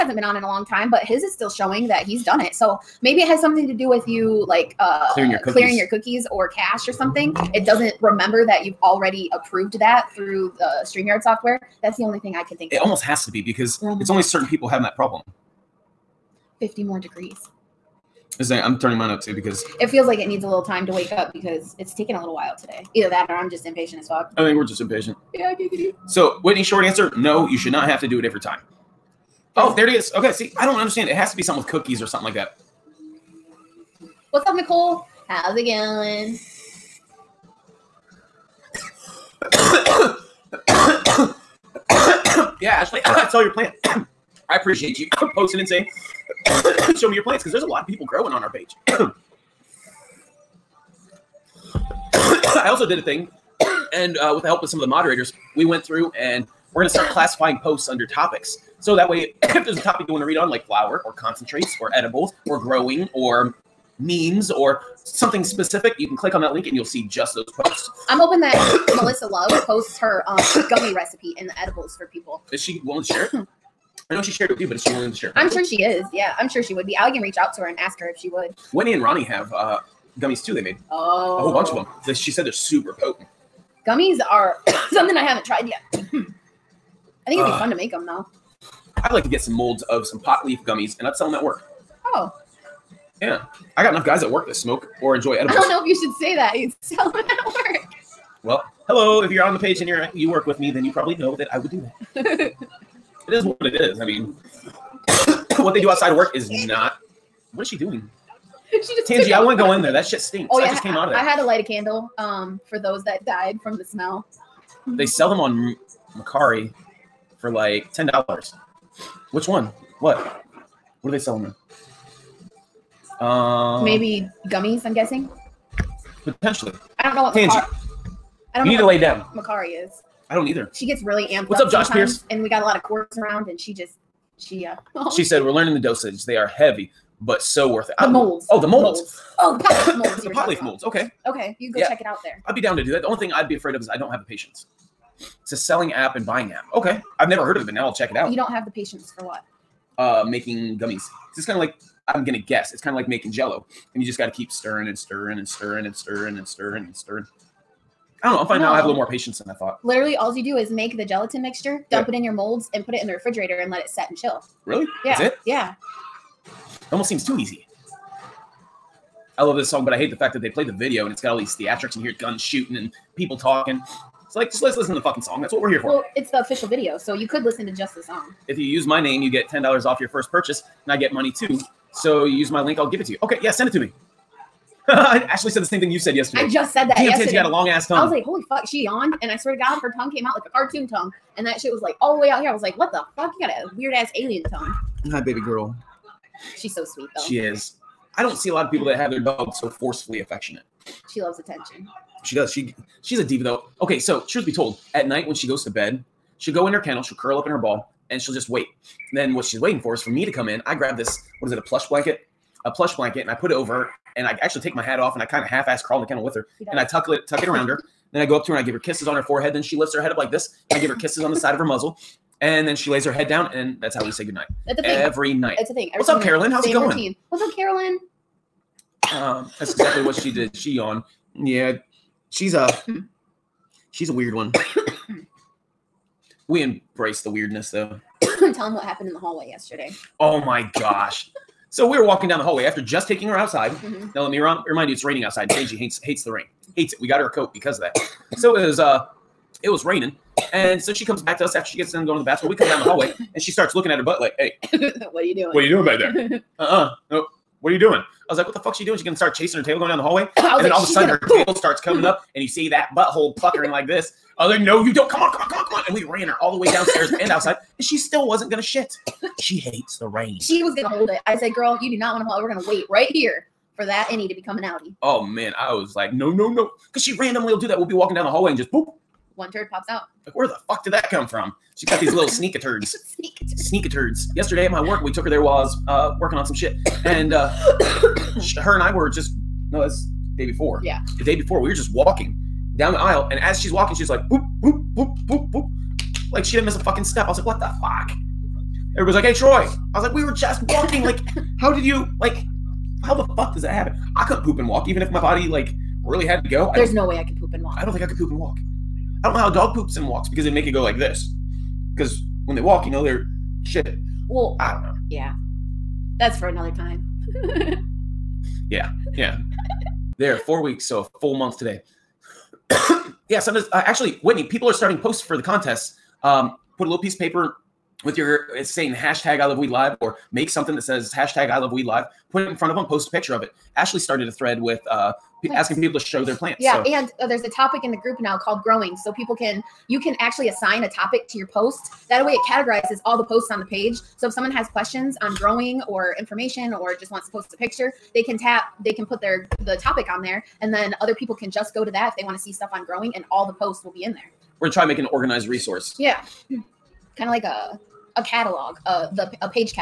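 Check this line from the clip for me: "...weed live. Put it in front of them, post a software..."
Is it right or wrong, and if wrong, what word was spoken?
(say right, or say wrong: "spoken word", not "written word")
wrong: "picture", not "software".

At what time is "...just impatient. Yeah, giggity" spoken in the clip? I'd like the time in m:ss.
0:24.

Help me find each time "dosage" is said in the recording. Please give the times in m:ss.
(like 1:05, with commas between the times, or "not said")
2:15.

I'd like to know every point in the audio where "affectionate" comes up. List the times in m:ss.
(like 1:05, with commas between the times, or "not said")
3:20.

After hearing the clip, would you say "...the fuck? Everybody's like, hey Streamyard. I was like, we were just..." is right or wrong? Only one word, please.
wrong.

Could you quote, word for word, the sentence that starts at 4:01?
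so we were walking down the hallway after just taking her outside.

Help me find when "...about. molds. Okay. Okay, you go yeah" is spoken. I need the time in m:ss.
2:20.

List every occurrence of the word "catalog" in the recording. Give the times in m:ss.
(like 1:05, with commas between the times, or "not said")
5:58.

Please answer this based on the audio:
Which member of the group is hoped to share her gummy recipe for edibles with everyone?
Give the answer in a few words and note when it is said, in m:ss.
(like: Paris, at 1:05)
Melissa Love, at 1:09.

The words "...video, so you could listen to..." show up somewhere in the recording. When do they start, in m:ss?
2:56.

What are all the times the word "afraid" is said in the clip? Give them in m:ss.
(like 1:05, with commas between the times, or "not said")
2:23.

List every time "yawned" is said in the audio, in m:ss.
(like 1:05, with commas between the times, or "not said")
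3:08, 3:50.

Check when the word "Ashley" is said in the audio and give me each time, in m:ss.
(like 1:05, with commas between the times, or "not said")
0:42, 3:04, 5:33.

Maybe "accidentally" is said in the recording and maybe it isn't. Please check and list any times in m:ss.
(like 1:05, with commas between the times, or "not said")
not said.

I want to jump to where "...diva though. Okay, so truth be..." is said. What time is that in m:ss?
3:23.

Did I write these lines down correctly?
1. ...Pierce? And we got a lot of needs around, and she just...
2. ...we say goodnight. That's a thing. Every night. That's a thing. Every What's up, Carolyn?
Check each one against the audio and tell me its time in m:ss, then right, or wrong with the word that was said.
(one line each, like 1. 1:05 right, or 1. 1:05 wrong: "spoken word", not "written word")
1. 2:11 wrong: "cords", not "needs"
2. 3:44 right.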